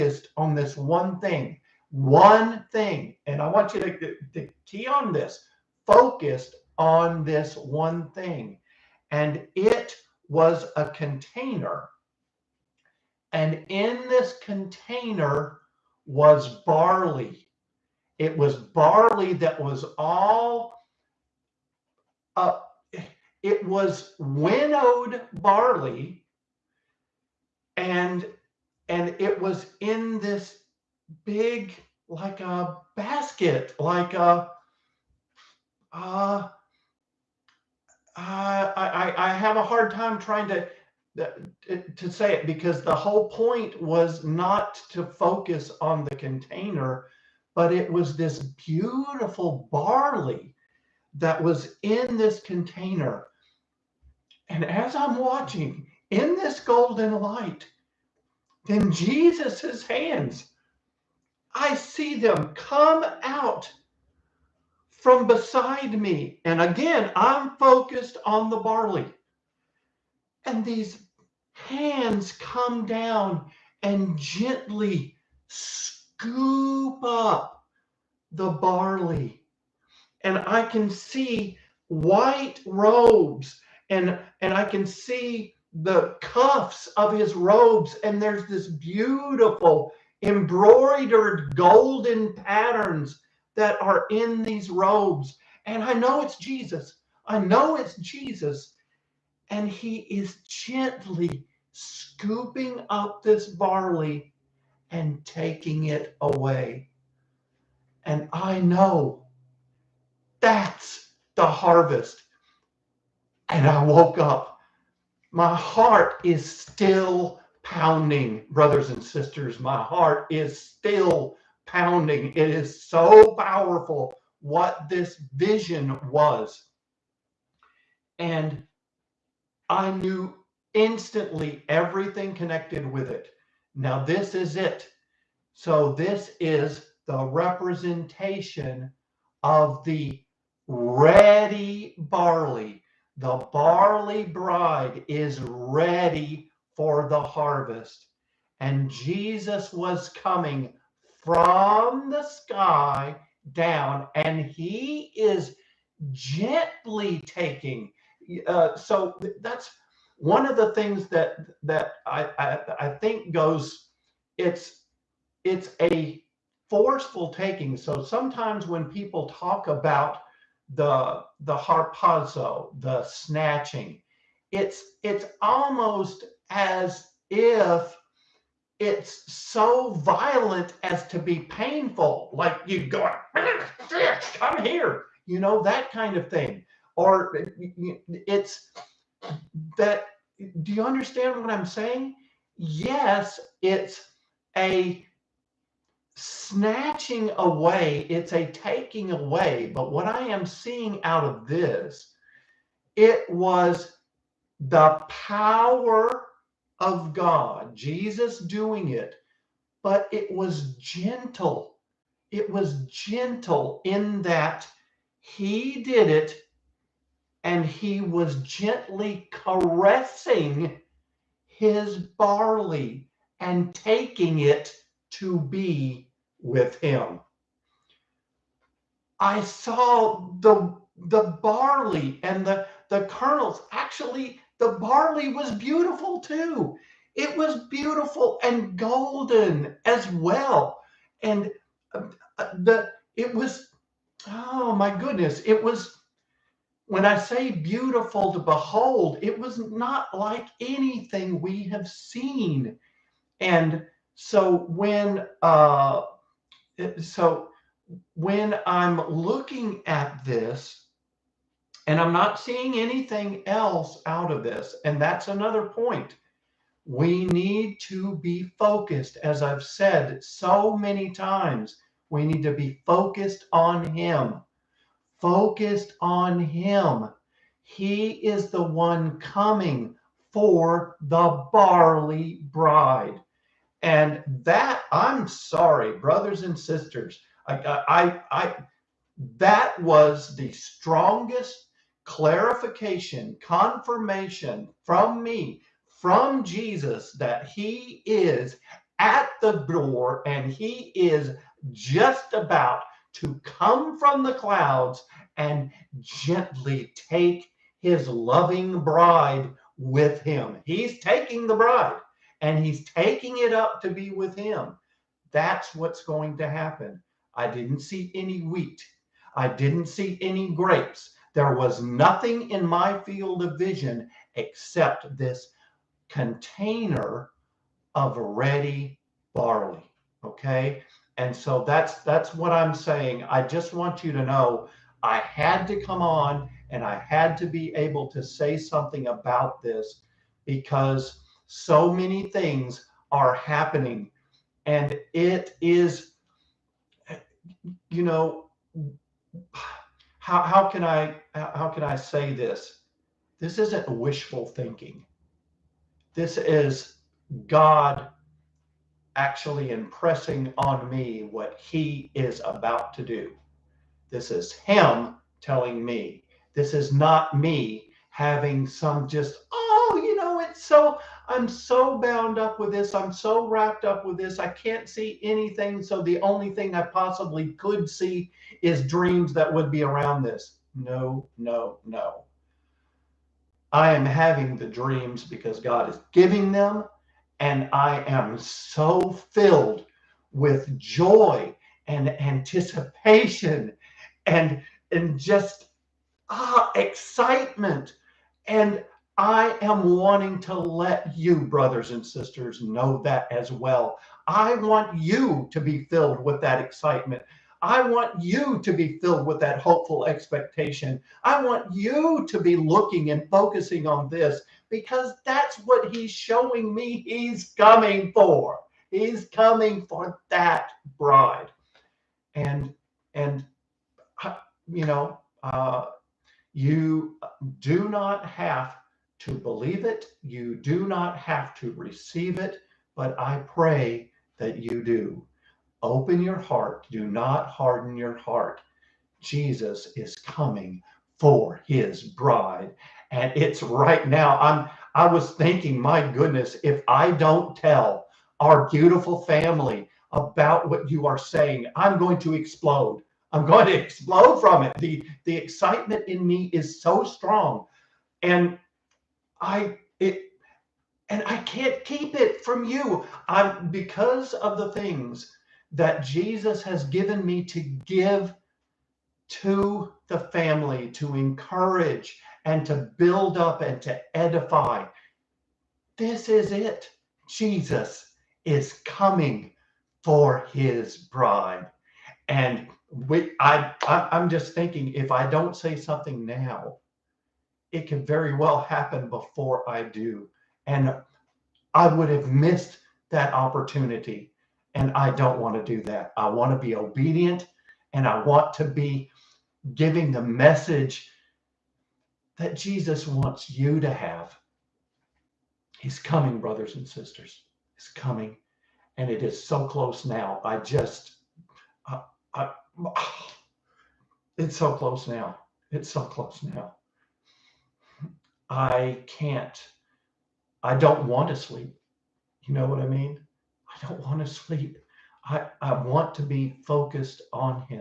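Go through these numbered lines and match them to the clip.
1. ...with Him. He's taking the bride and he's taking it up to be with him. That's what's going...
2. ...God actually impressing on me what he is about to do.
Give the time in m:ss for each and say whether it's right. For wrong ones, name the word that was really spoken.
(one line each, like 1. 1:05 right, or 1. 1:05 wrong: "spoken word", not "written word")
1. 5:09 right
2. 5:57 right.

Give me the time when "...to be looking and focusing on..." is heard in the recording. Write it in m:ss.
6:52.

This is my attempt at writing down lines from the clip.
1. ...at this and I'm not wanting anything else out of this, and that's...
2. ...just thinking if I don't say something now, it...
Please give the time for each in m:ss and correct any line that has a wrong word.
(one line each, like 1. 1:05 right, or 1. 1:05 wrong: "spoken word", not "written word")
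1. 4:19 wrong: "seeing", not "wanting"
2. 8:04 right.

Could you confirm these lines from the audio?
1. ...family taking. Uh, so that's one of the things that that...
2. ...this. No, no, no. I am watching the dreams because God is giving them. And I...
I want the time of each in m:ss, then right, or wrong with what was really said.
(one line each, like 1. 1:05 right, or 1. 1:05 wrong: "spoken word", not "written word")
1. 2:36 wrong: "gently", not "family"
2. 6:20 wrong: "having", not "watching".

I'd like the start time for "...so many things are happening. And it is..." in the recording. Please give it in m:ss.
5:41.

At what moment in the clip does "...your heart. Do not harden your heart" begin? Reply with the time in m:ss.
7:16.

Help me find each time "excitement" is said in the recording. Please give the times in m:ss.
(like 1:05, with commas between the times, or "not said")
6:36, 6:46, 7:35.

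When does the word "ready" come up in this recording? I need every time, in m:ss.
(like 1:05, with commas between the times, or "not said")
2:20, 2:25, 5:28.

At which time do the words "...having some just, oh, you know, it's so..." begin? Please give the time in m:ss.
6:08.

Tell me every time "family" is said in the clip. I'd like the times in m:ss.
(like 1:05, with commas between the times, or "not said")
7:29, 7:50.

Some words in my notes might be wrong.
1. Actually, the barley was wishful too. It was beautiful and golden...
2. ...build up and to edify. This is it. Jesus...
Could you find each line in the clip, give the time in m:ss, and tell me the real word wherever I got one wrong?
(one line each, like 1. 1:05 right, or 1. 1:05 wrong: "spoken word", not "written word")
1. 3:53 wrong: "beautiful", not "wishful"
2. 7:52 right.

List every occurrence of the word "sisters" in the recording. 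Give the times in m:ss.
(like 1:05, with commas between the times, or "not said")
1:59, 4:46, 6:42, 8:26.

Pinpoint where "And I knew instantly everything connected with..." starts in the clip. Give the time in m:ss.
2:08.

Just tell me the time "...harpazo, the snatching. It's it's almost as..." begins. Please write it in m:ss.
2:51.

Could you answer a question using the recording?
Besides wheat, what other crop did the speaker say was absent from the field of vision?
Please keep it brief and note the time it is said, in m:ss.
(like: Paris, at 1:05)
Grapes, at 5:20.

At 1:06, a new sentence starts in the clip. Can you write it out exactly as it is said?
And again, I'm focused on the barley.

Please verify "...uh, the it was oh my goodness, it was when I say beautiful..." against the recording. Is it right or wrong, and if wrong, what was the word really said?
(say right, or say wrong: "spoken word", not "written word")
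right.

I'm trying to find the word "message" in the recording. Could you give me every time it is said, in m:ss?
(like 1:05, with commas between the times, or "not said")
8:20.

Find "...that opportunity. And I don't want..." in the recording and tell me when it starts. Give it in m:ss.
8:13.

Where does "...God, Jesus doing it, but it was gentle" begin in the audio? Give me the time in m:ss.
3:27.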